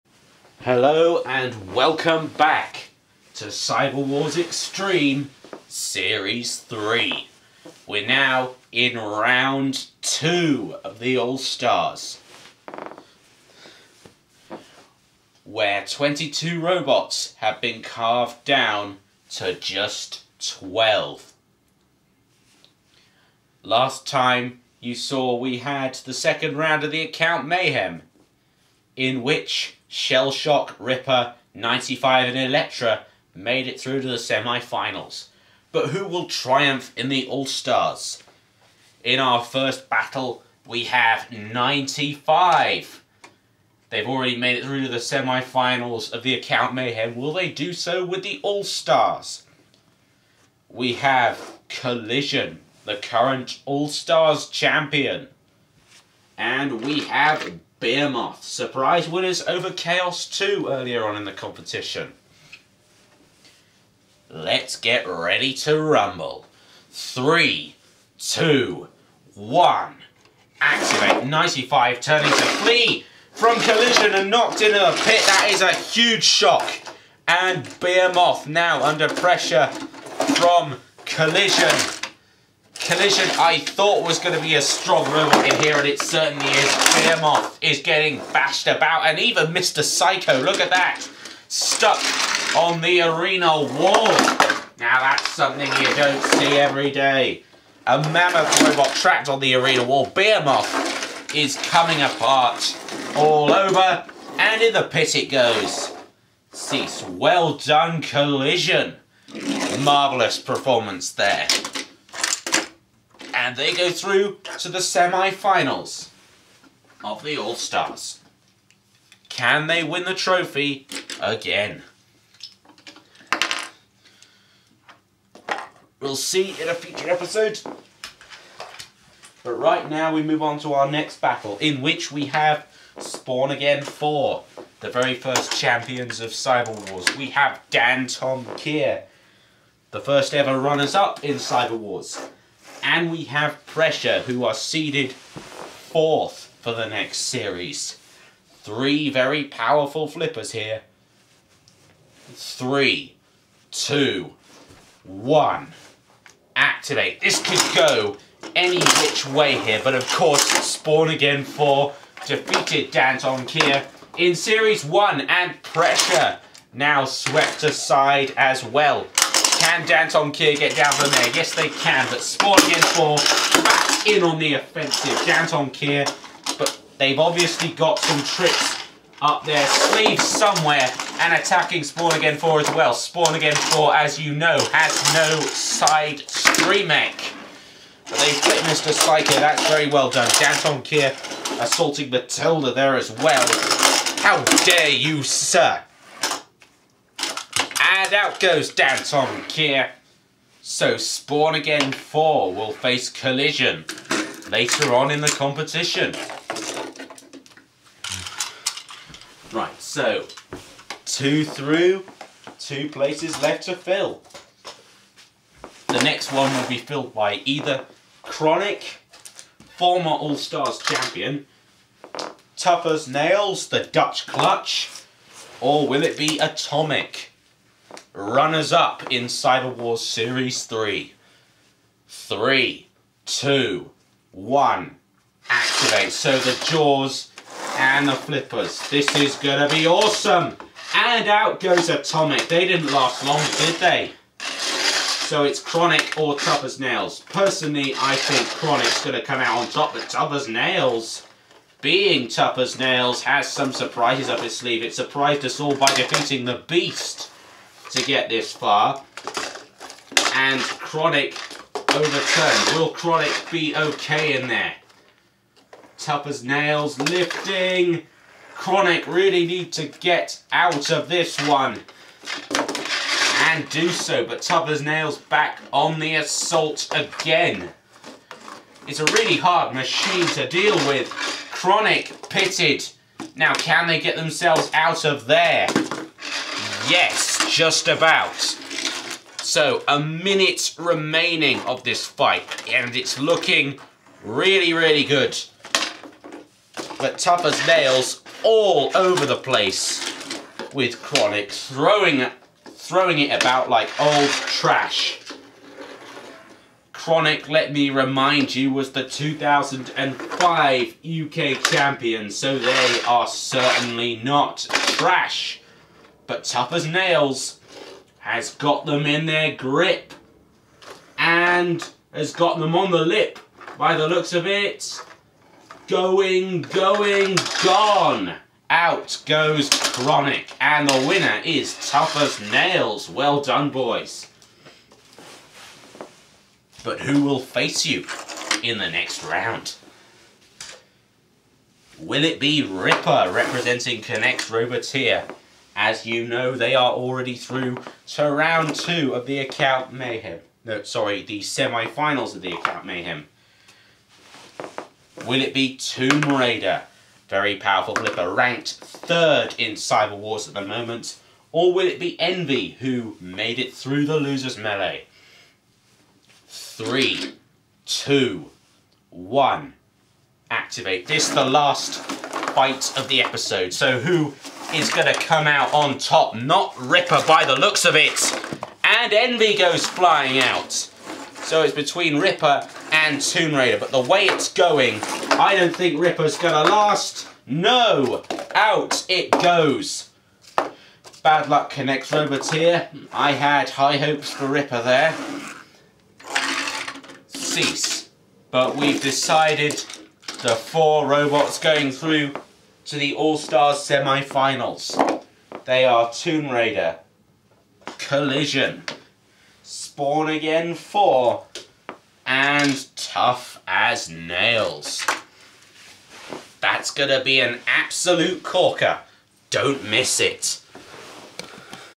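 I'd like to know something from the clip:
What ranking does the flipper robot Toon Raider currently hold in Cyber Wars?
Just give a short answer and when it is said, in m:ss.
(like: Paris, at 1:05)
Third, at 5:58.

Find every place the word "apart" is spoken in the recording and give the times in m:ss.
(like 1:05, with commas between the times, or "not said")
1:42.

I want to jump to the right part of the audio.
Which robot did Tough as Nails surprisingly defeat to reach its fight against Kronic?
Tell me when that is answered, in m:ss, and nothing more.
4:16.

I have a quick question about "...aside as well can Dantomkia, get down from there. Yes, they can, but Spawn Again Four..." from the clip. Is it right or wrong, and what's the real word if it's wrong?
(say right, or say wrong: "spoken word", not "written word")
right.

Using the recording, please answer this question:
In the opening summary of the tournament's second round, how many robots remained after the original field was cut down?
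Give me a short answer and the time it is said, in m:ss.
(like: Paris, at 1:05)
12, at 0:20.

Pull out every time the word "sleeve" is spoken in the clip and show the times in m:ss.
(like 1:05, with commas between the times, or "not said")
2:59, 4:14.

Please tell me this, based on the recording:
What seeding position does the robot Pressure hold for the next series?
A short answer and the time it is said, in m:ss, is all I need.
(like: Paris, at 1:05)
Fourth, at 2:24.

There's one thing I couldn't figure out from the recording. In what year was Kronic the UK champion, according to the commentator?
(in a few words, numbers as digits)
2005.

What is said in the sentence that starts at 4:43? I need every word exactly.
Now, can they get themselves out of there?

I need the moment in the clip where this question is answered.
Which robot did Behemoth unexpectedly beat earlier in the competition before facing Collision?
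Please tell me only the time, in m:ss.
0:59.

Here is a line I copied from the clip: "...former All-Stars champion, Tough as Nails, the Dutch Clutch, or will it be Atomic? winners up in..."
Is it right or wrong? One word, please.
wrong.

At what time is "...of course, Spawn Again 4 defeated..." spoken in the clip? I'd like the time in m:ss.
2:39.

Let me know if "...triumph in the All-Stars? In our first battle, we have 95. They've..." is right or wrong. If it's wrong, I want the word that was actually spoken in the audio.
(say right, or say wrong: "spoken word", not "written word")
right.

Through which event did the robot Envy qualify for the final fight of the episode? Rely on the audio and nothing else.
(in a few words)
The Losers Melee.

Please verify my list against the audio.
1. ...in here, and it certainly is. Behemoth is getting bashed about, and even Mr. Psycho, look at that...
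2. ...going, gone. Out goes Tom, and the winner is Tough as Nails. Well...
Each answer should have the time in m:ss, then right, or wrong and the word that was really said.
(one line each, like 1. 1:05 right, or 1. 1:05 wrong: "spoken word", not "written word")
1. 1:25 right
2. 5:26 wrong: "Kronic", not "Tom".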